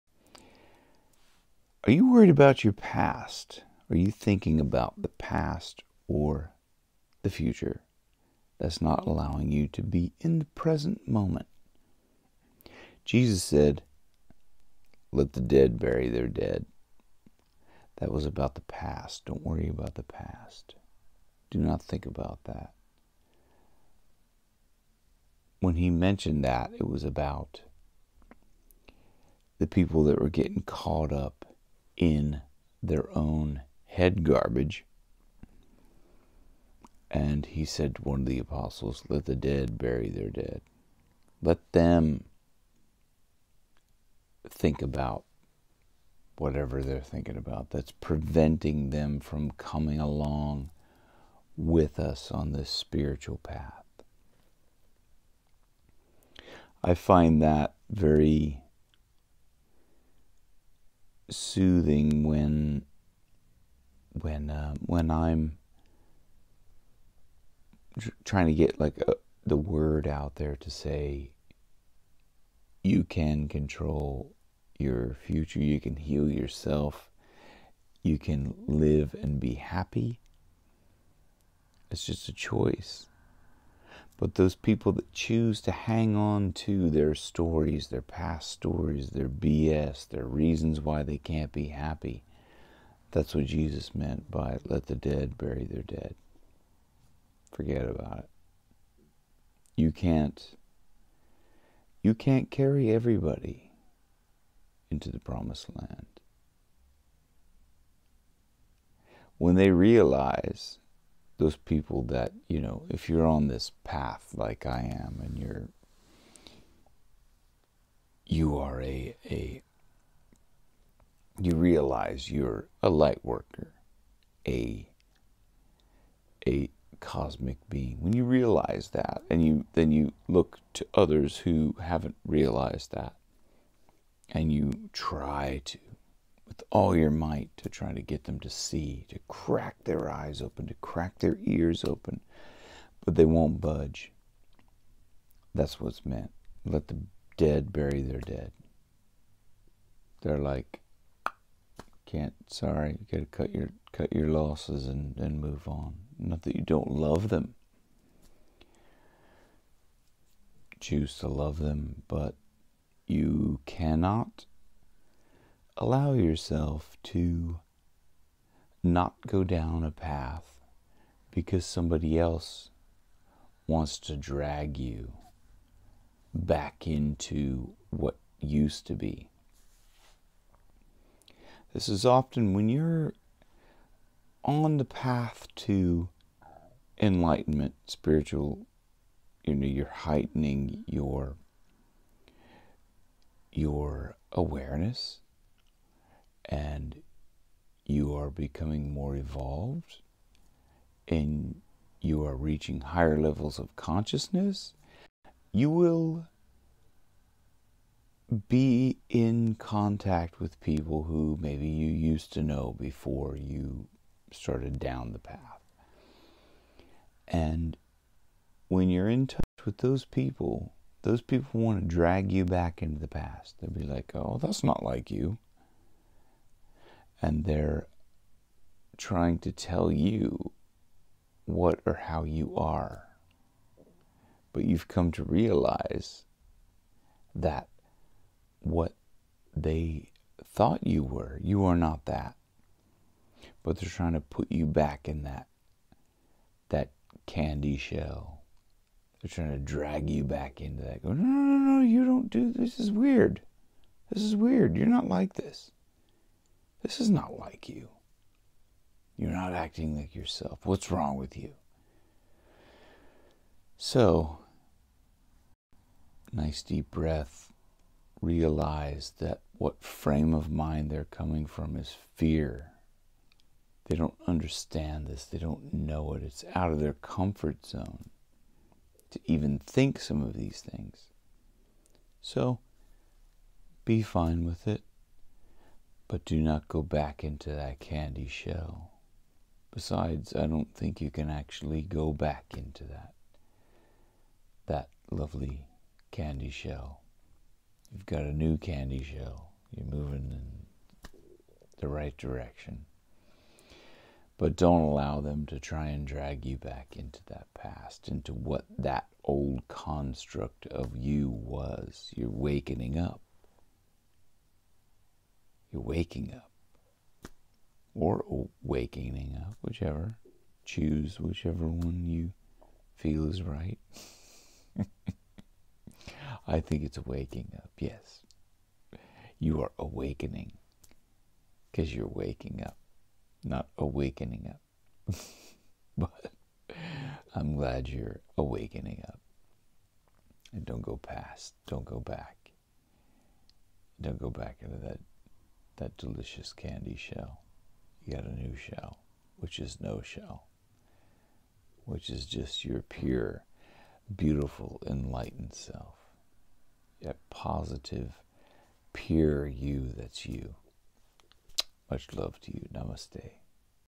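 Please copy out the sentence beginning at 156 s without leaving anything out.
Not that you don't love them.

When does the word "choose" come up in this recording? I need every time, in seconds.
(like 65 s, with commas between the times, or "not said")
85 s, 160 s, 320 s.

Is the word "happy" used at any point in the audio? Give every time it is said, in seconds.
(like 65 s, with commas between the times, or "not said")
79 s, 91 s.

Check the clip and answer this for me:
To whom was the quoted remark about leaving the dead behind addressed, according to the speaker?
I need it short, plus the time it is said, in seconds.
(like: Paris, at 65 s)
one of the apostles, at 38 s.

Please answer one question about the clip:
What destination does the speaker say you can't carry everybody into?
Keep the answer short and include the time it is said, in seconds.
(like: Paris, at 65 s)
the promised land, at 105 s.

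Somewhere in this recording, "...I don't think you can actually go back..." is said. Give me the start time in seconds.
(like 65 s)
290 s.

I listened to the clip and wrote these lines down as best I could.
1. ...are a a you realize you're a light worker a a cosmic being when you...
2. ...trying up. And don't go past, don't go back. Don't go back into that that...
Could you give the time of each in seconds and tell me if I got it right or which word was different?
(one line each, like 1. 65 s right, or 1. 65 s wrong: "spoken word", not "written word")
1. 118 s right
2. 338 s wrong: "awakening", not "trying".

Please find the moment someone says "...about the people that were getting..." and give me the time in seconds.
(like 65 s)
27 s.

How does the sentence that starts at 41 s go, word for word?
Let them think about whatever they're thinking about that's preventing them from coming along with us on this spiritual path.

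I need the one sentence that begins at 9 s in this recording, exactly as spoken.
allowing you to be in the present moment?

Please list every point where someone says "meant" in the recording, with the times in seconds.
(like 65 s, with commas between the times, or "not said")
93 s, 146 s.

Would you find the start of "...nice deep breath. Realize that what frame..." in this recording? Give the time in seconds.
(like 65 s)
266 s.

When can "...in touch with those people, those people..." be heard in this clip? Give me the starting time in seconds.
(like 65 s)
219 s.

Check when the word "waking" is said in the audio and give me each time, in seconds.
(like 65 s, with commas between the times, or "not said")
315 s, 327 s, 332 s.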